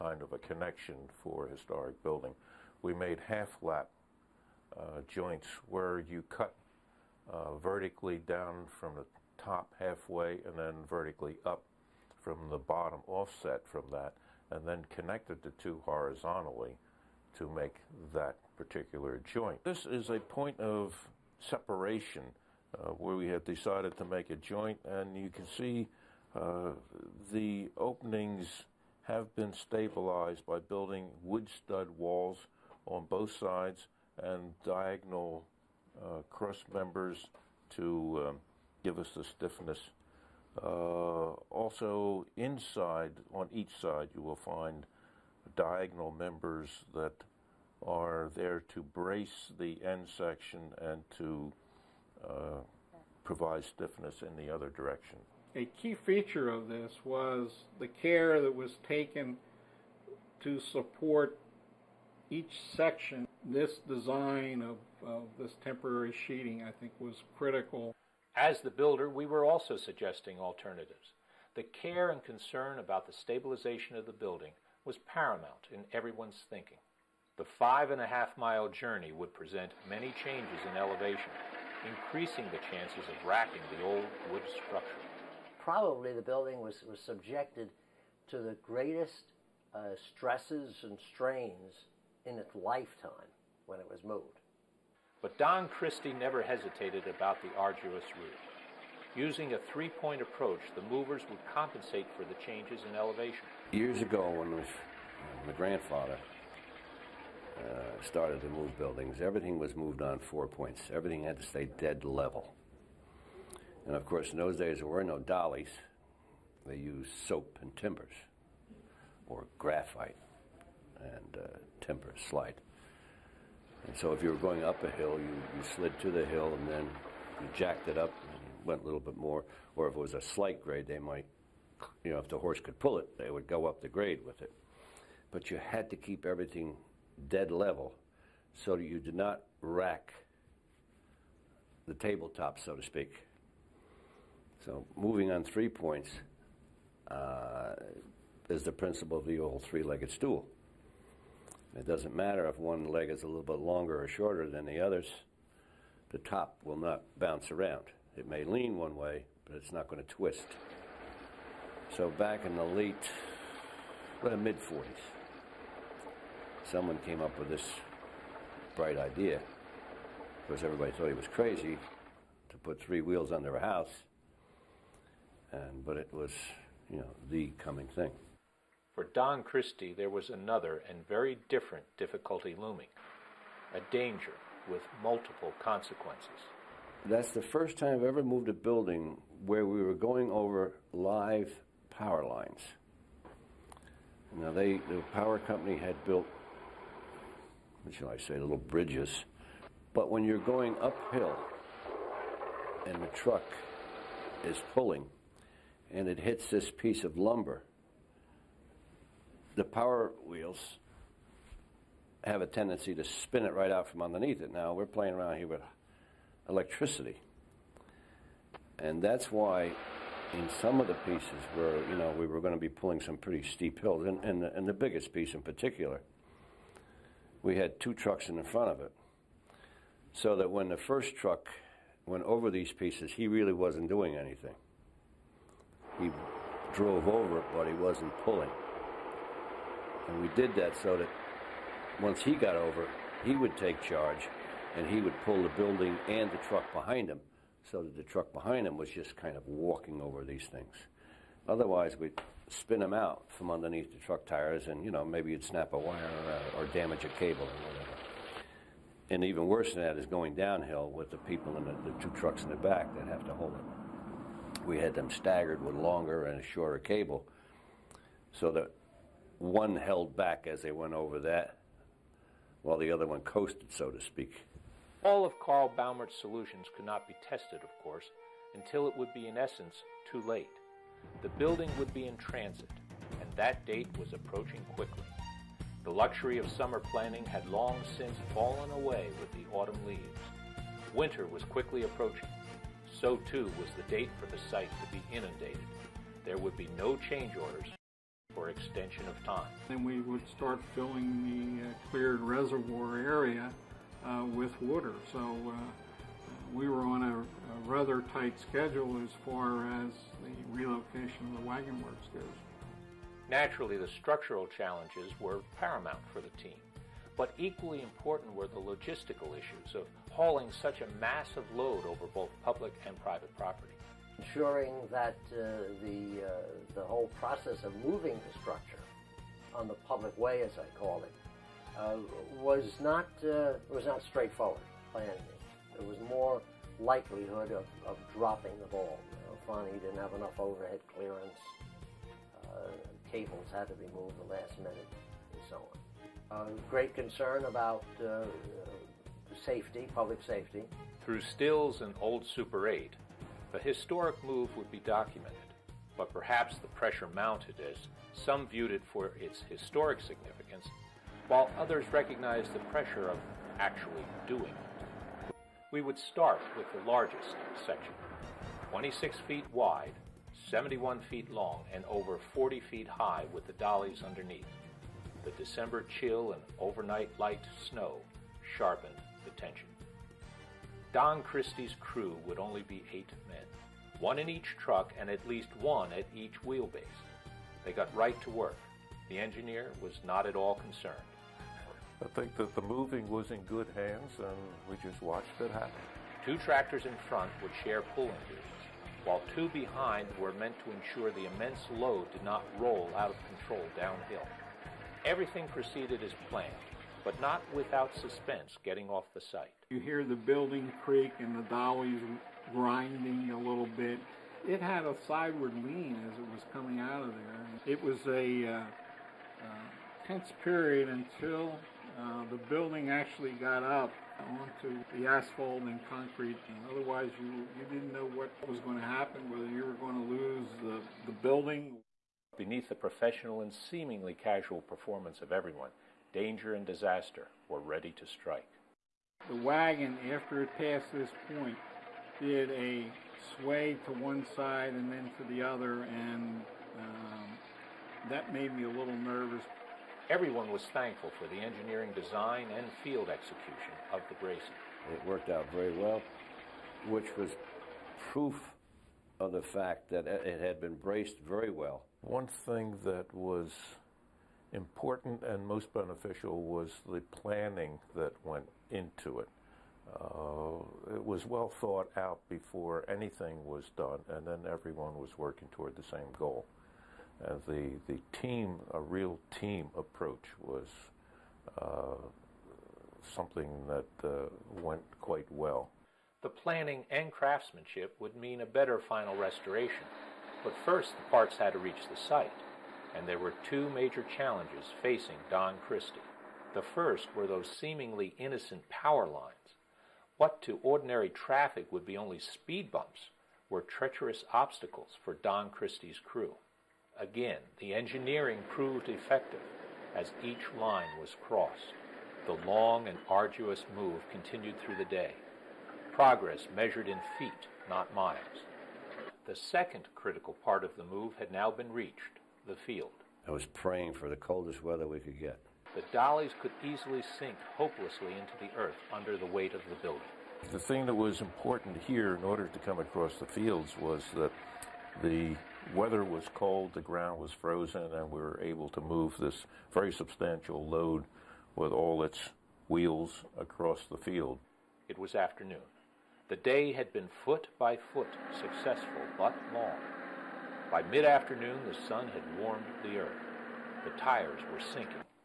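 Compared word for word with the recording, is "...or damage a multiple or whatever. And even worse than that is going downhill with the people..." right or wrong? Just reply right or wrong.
wrong.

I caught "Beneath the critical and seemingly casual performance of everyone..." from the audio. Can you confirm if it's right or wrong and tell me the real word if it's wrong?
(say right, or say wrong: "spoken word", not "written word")
wrong: "professional", not "critical".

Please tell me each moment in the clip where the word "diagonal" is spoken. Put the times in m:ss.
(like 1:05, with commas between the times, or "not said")
0:34, 0:45.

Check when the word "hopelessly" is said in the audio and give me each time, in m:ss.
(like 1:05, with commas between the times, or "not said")
8:47.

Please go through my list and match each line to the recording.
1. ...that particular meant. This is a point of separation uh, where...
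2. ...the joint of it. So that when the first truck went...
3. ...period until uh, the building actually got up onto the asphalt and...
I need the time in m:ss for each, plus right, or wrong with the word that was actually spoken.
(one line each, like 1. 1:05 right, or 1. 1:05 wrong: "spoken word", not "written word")
1. 0:18 wrong: "joint", not "meant"
2. 3:48 wrong: "front", not "joint"
3. 7:00 right.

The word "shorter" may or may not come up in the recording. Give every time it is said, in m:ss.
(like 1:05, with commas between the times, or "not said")
2:34, 4:26.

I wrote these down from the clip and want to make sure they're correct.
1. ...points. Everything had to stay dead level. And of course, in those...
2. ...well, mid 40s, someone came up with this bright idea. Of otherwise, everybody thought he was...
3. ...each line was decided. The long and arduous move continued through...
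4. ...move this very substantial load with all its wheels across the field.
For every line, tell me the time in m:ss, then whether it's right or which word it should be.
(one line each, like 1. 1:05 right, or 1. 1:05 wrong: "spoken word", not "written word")
1. 1:50 right
2. 2:44 wrong: "course", not "otherwise"
3. 8:30 wrong: "crossed", not "decided"
4. 8:58 right.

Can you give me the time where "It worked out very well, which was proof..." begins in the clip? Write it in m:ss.
7:34.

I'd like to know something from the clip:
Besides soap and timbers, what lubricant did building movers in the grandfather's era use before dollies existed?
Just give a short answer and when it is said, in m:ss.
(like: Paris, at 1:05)
graphite, at 1:59.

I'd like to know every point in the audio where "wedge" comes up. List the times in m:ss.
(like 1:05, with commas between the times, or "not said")
not said.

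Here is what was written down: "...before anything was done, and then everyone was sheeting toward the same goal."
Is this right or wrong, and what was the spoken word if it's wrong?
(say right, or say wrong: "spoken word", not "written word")
wrong: "working", not "sheeting".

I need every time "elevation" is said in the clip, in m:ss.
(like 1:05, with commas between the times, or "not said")
1:20, 1:42.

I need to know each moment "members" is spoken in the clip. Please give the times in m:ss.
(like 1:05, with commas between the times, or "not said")
0:36, 0:46.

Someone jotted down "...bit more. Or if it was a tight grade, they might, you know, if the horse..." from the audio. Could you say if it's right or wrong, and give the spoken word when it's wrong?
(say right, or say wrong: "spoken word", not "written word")
wrong: "slight", not "tight".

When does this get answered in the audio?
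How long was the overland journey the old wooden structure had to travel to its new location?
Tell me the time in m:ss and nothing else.
1:17.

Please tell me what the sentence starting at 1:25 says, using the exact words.
Probably the building was, was subjected to the greatest uh, stresses and strains in its lifetime when it was moved.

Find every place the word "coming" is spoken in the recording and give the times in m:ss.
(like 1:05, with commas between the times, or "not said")
2:57, 6:56.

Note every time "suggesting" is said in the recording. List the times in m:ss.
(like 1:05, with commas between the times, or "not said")
1:09.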